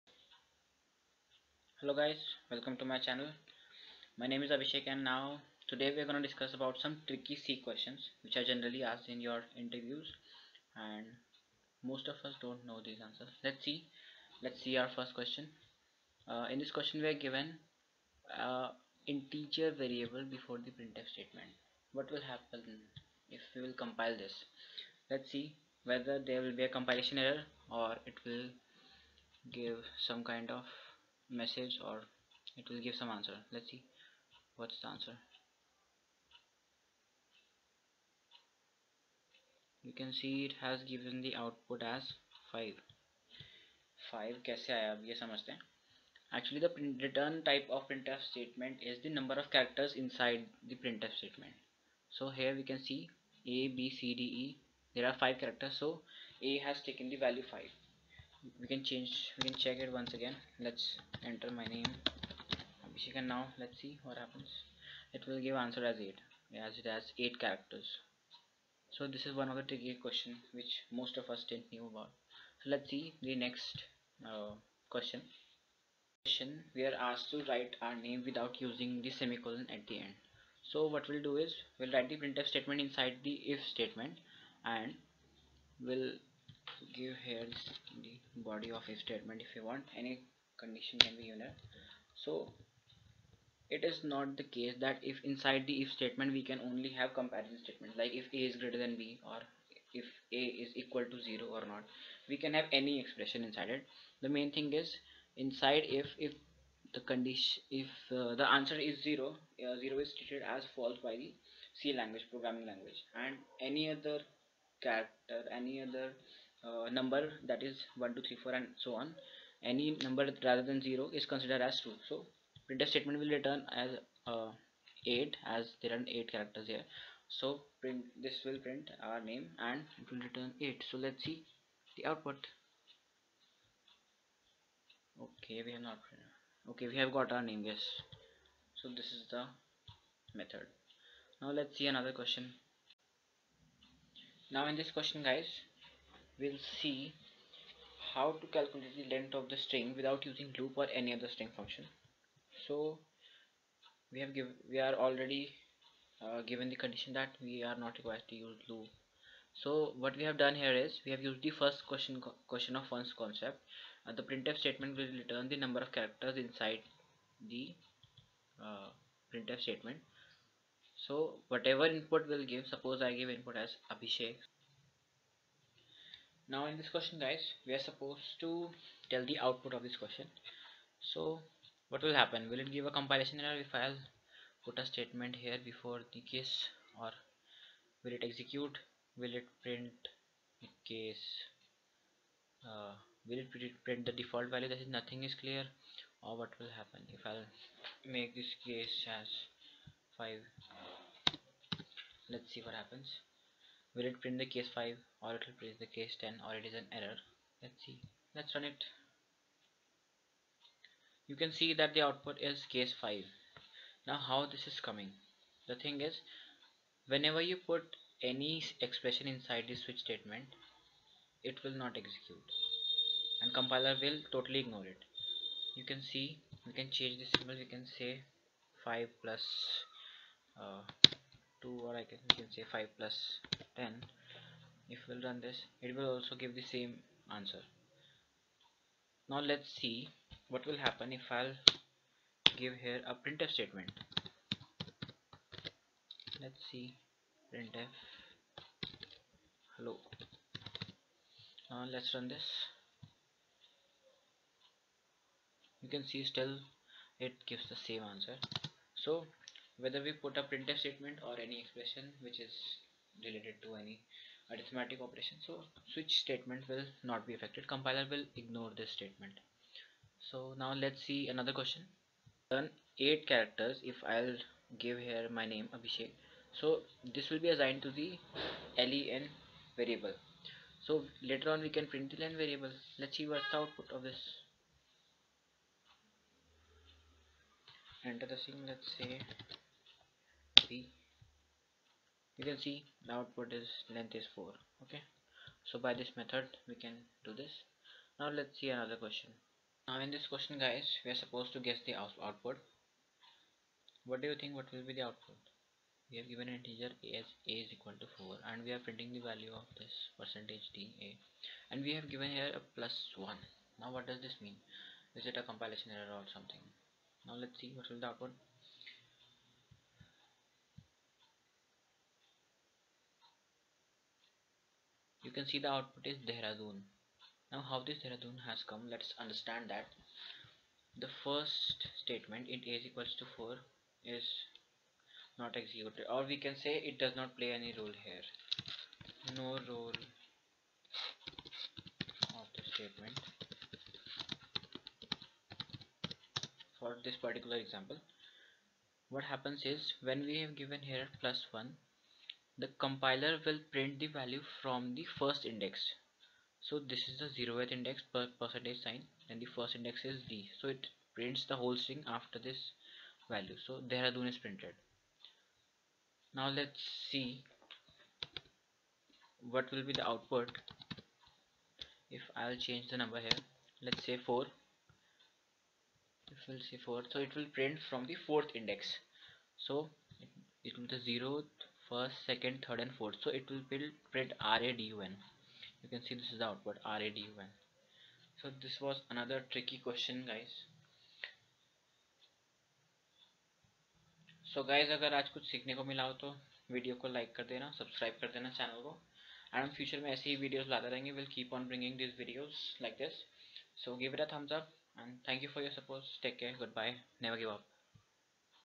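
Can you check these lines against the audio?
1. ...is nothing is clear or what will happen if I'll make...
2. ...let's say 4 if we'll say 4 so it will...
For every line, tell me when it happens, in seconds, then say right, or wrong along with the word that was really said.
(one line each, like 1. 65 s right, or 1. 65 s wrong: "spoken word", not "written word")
1. 194 s right
2. 373 s right.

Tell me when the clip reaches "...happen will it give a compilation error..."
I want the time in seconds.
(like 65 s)
182 s.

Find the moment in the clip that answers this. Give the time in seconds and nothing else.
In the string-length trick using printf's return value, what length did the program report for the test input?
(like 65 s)
293 s.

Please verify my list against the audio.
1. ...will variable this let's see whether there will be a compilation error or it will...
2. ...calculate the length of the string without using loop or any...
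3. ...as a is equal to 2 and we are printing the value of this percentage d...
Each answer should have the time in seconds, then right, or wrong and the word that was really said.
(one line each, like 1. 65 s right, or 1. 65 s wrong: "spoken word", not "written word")
1. 23 s wrong: "compile", not "variable"
2. 148 s right
3. 307 s wrong: "4", not "2".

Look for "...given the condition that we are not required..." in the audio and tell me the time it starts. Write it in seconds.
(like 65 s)
156 s.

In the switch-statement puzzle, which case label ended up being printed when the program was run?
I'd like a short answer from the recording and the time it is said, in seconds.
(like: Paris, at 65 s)
case 5, at 211 s.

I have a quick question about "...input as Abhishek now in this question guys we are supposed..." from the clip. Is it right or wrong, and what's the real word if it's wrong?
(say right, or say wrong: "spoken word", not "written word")
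right.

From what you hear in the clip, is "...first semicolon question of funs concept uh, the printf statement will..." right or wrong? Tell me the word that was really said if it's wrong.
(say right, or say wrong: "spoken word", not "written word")
wrong: "question", not "semicolon".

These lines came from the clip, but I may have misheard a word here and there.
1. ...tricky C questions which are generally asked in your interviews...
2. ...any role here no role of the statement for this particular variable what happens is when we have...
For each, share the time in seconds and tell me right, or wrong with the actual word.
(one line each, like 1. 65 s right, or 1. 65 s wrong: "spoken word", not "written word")
1. 7 s right
2. 337 s wrong: "example", not "variable".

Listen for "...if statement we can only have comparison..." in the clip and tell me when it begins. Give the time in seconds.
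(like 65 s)
95 s.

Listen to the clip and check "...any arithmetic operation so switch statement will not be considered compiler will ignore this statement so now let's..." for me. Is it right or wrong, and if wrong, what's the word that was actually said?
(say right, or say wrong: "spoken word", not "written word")
wrong: "affected", not "considered".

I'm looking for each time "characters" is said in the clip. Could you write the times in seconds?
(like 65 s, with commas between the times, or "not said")
49 s, 55 s, 67 s, 114 s, 126 s, 165 s, 273 s.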